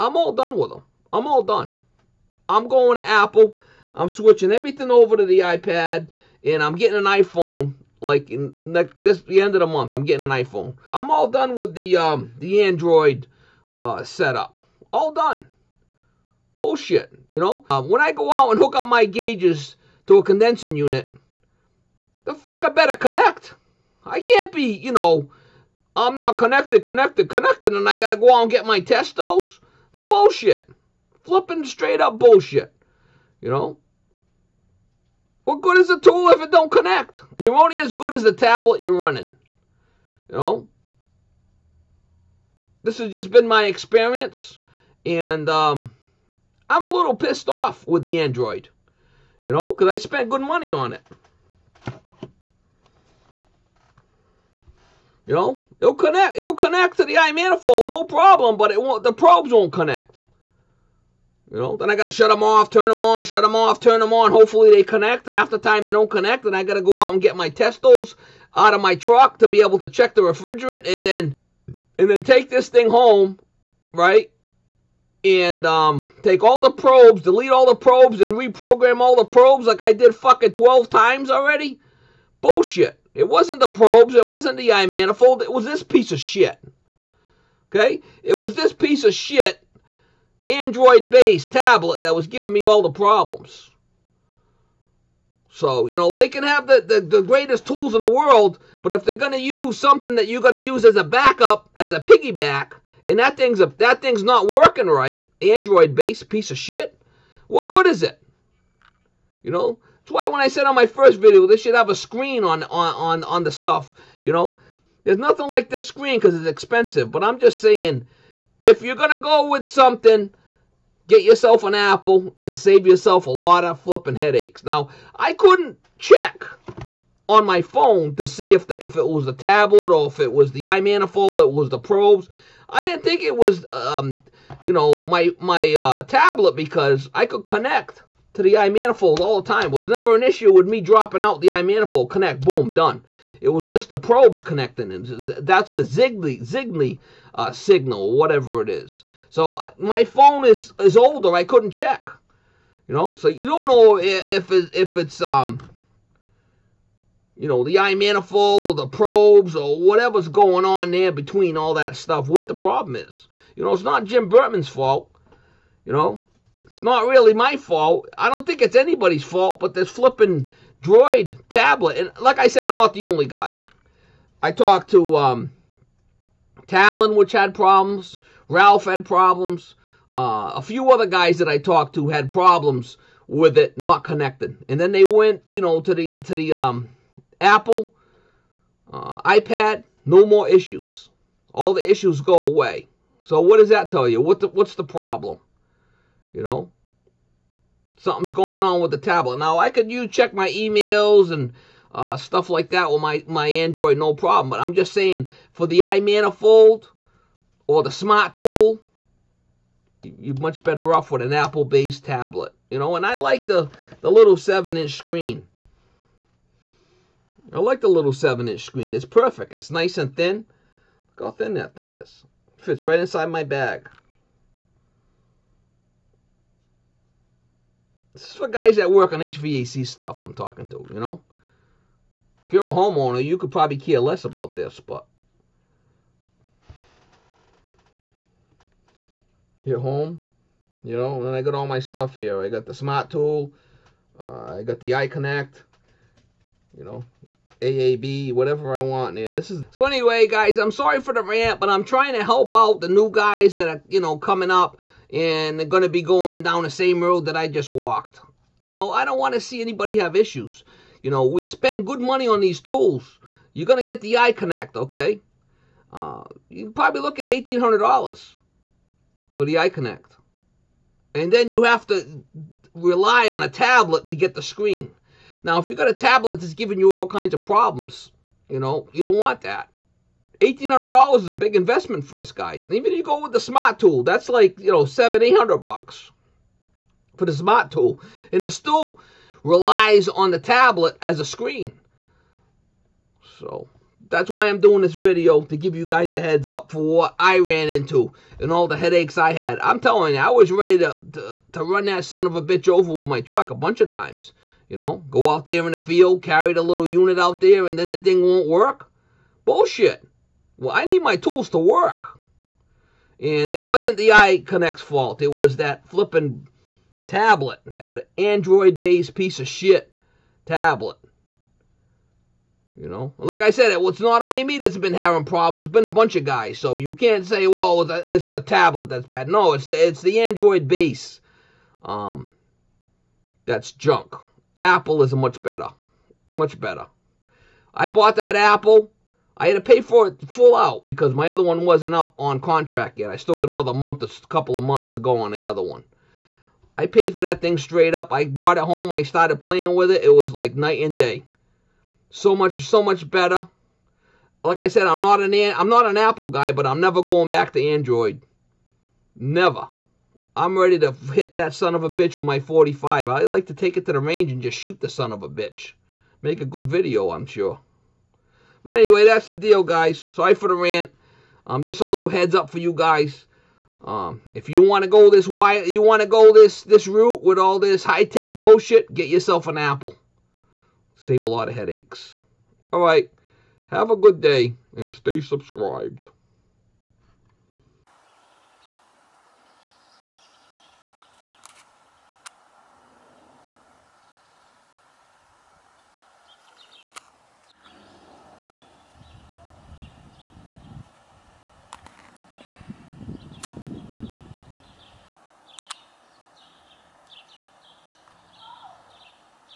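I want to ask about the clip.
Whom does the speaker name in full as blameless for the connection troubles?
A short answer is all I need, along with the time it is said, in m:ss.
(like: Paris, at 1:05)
Jim Burtman, at 2:44.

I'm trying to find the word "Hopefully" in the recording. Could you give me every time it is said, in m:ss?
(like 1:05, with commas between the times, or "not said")
1:04.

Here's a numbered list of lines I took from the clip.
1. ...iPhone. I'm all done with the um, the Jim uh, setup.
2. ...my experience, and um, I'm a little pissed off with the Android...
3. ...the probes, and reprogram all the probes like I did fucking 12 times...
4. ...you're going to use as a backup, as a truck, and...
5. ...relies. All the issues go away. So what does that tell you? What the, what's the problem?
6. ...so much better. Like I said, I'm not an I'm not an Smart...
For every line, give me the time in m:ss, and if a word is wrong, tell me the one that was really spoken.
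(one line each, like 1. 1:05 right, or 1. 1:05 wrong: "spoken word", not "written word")
1. 0:10 wrong: "Android", not "Jim"
2. 0:43 right
3. 1:17 right
4. 1:40 wrong: "piggyback", not "truck"
5. 3:10 wrong: "issues", not "relies"
6. 5:52 wrong: "Apple", not "Smart".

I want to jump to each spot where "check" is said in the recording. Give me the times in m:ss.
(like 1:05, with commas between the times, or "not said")
1:09, 2:05, 2:31, 3:20.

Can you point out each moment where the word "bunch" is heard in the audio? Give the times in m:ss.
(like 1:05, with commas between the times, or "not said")
5:03, 5:25.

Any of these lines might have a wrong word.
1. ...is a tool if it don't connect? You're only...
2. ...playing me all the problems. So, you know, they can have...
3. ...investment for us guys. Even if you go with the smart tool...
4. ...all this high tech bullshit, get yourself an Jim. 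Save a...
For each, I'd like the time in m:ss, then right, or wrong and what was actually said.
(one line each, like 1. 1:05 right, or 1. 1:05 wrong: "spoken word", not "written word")
1. 0:35 right
2. 1:32 wrong: "giving", not "playing"
3. 4:41 right
4. 6:17 wrong: "Apple", not "Jim".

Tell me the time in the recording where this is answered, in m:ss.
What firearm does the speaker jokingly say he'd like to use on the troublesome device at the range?
6:02.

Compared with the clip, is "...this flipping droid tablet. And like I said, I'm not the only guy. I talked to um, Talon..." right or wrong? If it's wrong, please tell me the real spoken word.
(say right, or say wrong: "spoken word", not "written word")
right.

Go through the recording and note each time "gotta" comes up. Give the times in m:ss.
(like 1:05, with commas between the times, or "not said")
0:27, 1:01, 1:06.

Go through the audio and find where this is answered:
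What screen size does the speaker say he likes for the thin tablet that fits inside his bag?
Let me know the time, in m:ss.
3:38.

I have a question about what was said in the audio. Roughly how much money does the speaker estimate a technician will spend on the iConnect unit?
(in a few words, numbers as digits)
$1,800.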